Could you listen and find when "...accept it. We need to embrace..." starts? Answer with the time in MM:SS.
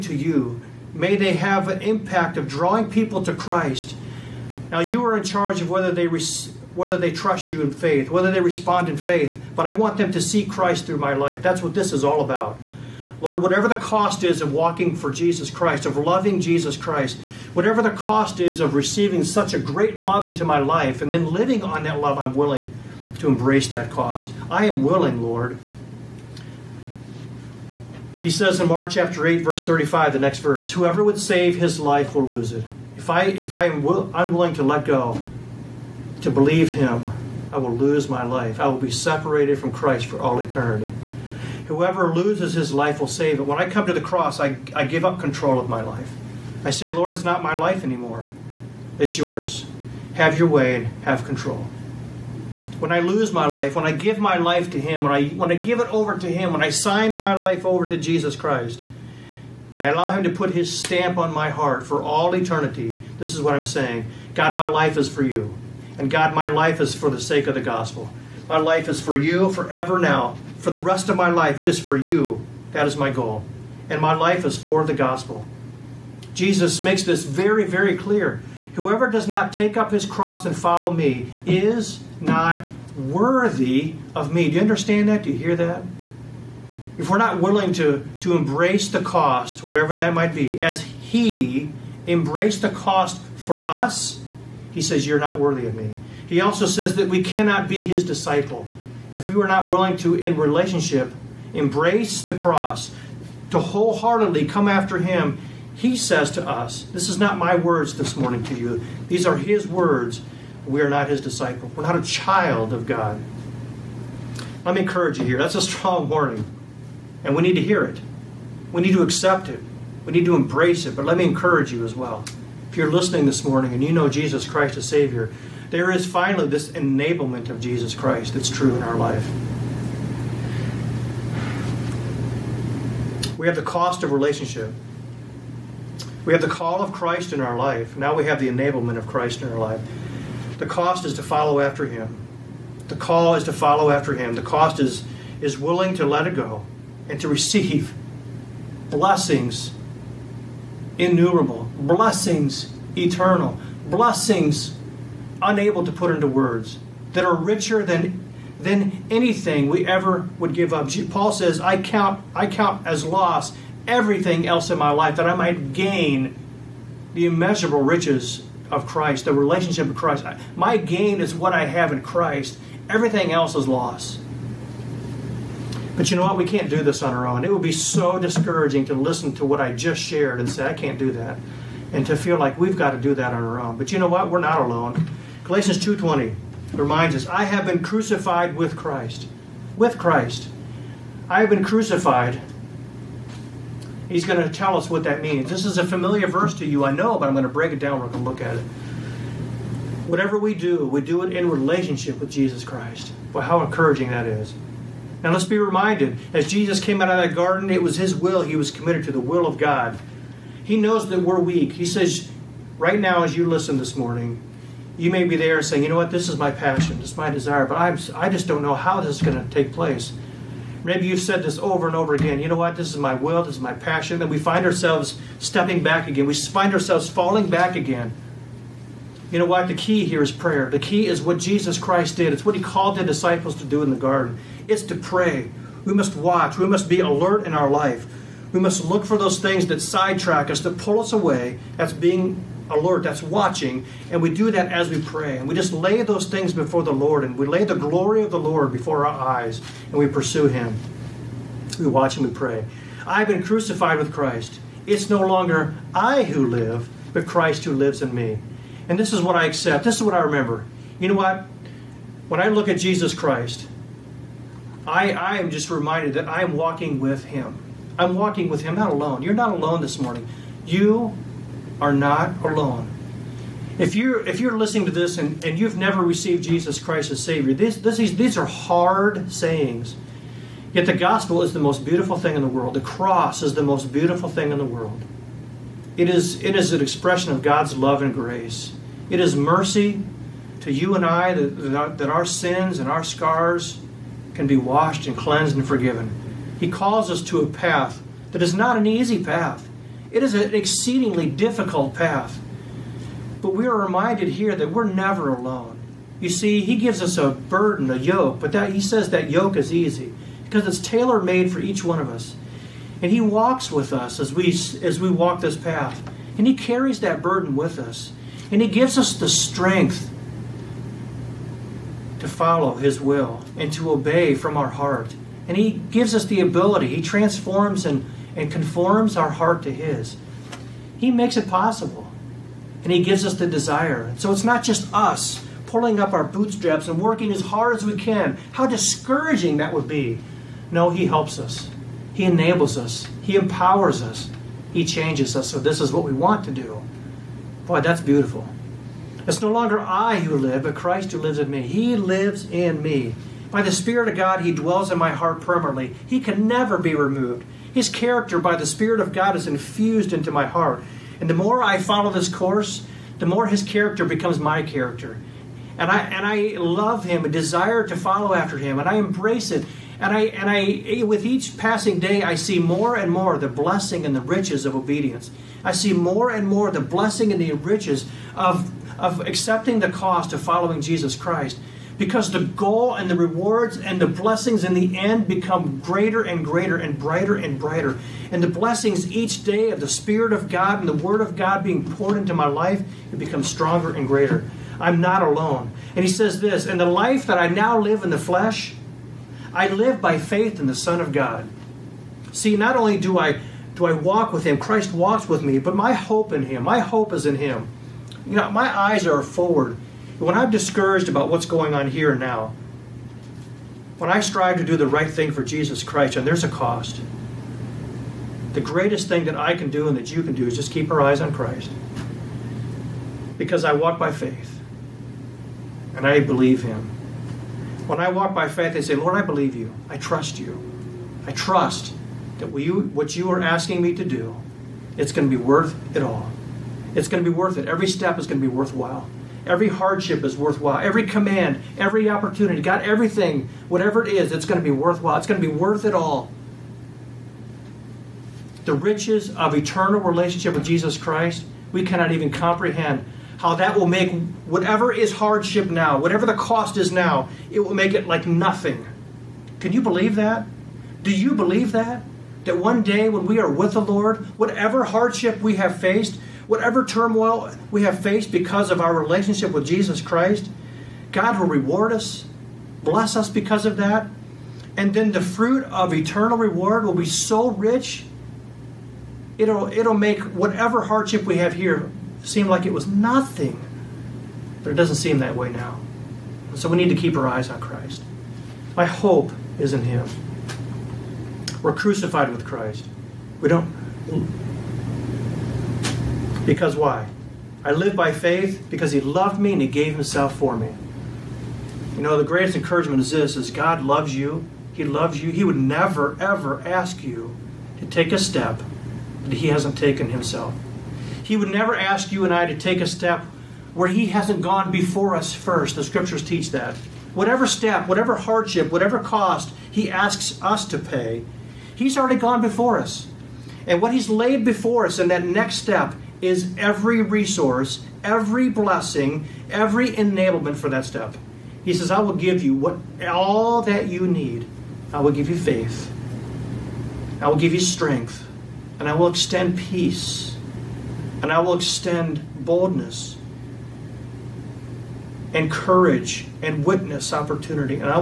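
01:59.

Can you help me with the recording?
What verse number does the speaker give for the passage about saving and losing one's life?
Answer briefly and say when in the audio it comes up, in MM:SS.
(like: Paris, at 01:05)
35, at 00:29.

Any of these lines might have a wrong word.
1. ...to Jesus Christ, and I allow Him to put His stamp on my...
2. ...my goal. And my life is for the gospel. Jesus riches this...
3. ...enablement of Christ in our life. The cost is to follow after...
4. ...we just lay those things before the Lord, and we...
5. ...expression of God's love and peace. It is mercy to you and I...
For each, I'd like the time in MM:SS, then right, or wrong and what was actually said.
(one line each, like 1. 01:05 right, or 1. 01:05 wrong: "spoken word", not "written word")
1. 00:57 right
2. 01:12 wrong: "makes", not "riches"
3. 02:18 right
4. 04:05 right
5. 04:46 wrong: "grace", not "peace".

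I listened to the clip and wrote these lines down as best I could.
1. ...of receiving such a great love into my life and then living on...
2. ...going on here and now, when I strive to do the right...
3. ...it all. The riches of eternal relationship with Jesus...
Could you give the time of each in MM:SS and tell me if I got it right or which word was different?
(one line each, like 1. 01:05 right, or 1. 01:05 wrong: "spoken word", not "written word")
1. 00:18 right
2. 06:51 right
3. 07:25 right.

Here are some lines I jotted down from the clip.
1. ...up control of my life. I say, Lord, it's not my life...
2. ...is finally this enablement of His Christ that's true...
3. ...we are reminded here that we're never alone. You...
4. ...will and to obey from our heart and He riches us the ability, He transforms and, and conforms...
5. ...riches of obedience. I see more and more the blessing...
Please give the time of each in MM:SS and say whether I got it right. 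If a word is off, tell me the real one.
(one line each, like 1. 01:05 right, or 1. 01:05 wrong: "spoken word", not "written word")
1. 00:45 right
2. 02:05 wrong: "Jesus", not "His"
3. 05:03 right
4. 05:22 wrong: "gives", not "riches"
5. 06:14 right.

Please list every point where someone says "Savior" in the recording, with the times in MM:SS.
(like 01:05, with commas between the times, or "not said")
02:04, 04:37.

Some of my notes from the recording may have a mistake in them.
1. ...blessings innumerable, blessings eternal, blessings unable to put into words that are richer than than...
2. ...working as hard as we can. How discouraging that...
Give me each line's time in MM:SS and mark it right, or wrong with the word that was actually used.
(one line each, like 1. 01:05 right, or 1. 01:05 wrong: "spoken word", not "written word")
1. 02:28 right
2. 05:37 right.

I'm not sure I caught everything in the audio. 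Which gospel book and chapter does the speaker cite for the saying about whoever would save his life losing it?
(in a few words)
Mark 8.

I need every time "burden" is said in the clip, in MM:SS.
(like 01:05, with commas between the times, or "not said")
05:07, 05:17.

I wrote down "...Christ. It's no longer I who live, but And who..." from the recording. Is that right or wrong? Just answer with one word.
wrong.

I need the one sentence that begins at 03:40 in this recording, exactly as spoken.
Maybe you've said this over and over again.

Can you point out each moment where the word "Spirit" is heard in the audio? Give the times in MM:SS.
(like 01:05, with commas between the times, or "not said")
05:53, 05:58, 06:29.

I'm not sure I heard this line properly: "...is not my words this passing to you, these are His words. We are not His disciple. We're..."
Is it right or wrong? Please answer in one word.
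wrong.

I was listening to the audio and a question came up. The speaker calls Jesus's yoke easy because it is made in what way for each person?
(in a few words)
Tailor made.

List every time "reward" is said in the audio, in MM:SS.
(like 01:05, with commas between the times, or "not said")
06:23, 07:51, 07:56.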